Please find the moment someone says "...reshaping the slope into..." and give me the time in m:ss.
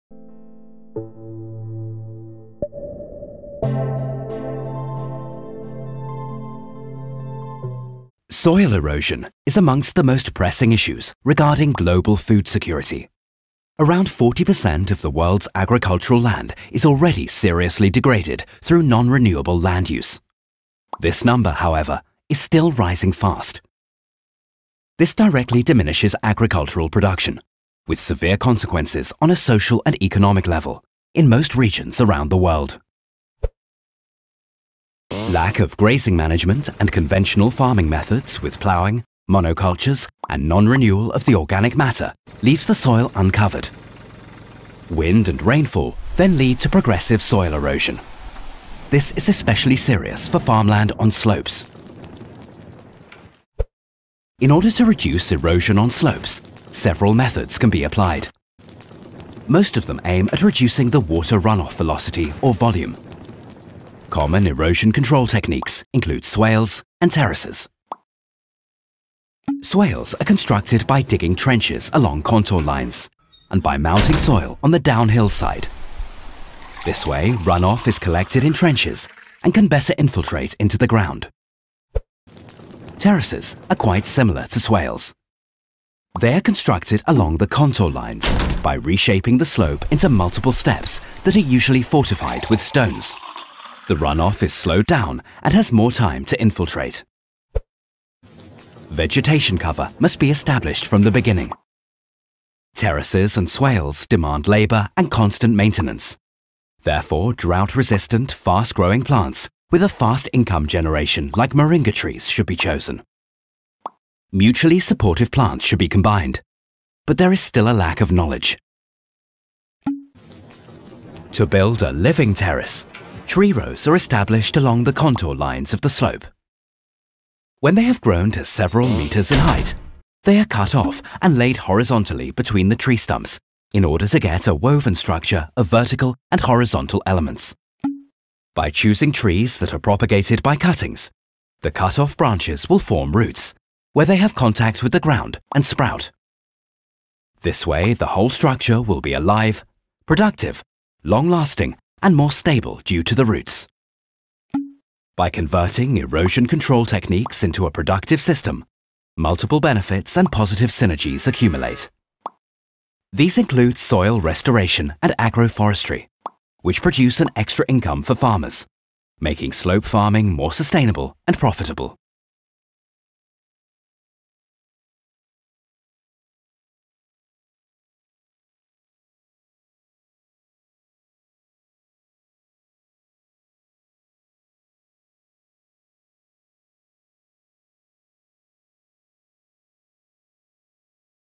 1:28.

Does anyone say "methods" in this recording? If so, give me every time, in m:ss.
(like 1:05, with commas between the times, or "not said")
0:37, 0:57.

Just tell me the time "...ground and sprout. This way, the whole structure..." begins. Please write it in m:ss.
2:24.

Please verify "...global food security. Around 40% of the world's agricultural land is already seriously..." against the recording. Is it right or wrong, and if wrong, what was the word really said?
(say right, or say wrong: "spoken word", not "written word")
right.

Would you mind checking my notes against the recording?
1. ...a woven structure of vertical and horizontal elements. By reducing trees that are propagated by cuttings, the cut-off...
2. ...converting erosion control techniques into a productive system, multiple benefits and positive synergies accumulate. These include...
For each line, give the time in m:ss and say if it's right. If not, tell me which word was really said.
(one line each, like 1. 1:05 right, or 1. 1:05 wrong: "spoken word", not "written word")
1. 2:14 wrong: "choosing", not "reducing"
2. 2:35 right.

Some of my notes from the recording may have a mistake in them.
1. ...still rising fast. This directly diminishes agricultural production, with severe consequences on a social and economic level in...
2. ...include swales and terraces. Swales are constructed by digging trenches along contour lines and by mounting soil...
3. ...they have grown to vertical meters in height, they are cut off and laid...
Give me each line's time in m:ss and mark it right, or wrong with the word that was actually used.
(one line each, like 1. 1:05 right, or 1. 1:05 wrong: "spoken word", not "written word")
1. 0:22 right
2. 1:05 right
3. 2:07 wrong: "several", not "vertical".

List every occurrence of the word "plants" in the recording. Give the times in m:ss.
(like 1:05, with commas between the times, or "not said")
1:49, 1:55.